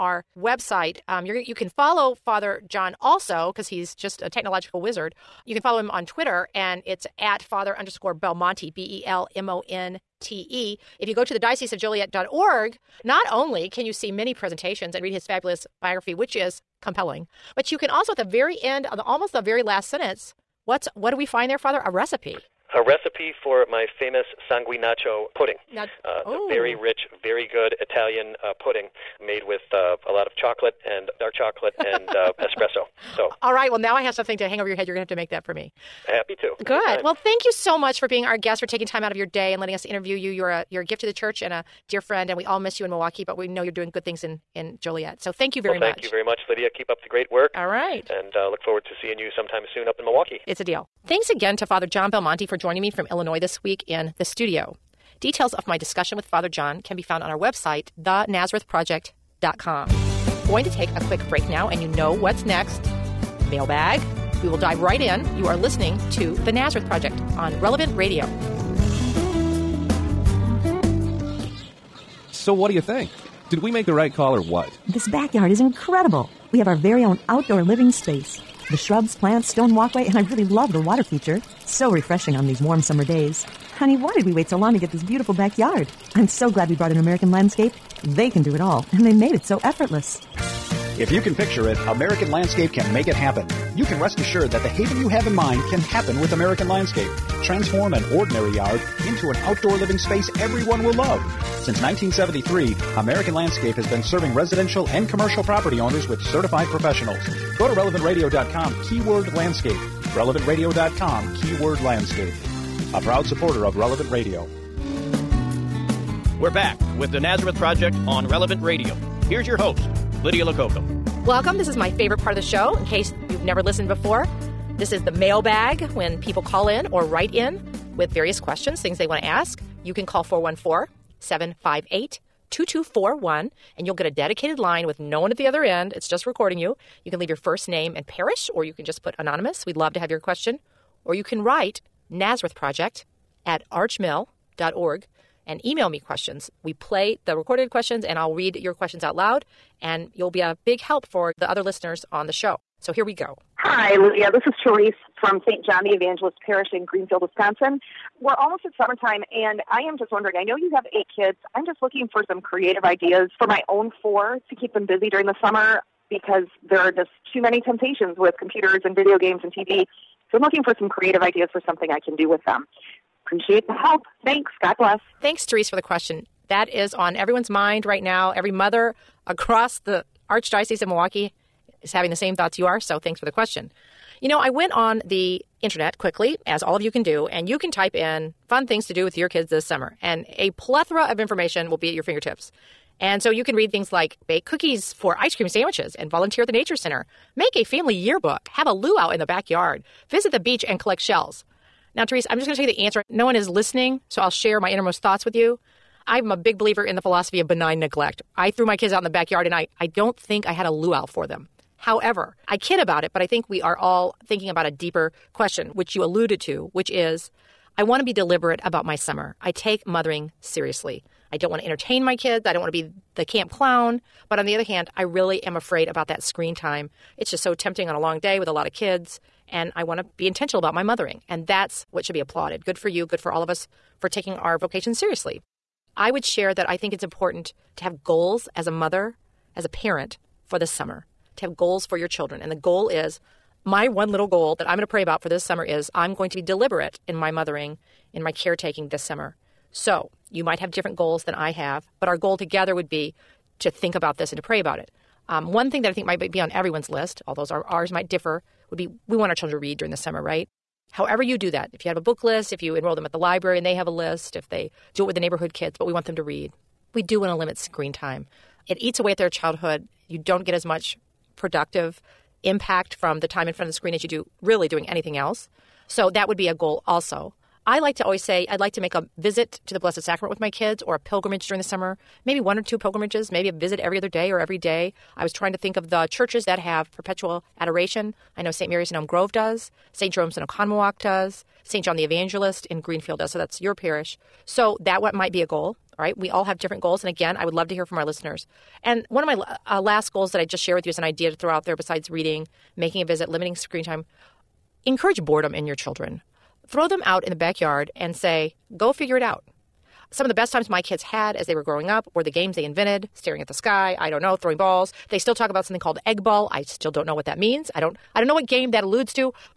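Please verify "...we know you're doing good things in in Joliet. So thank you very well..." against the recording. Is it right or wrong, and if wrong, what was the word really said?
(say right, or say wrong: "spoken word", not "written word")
right.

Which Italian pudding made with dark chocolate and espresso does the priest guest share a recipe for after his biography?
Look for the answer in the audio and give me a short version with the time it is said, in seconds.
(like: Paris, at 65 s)
sanguinaccio, at 24 s.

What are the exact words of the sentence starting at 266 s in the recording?
We do want to limit screen time.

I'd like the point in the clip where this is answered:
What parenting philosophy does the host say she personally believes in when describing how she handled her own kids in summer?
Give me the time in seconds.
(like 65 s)
207 s.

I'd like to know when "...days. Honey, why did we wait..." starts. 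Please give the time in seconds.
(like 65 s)
83 s.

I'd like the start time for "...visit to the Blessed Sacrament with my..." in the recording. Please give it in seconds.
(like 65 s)
279 s.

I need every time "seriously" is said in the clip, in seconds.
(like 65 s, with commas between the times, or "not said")
220 s, 234 s.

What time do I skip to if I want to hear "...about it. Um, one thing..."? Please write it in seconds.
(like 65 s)
254 s.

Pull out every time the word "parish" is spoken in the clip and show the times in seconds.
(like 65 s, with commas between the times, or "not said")
138 s, 156 s, 293 s.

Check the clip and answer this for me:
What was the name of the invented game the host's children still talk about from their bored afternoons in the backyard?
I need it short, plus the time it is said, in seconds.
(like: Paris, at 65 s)
egg ball, at 316 s.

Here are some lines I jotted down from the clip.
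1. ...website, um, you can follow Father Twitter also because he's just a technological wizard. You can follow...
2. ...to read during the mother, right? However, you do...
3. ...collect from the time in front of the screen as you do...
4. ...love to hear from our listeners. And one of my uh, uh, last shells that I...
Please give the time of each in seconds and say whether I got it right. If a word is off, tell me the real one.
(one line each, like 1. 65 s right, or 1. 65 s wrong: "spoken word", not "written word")
1. 0 s wrong: "John", not "Twitter"
2. 259 s wrong: "summer", not "mother"
3. 272 s wrong: "impact", not "collect"
4. 297 s wrong: "goals", not "shells".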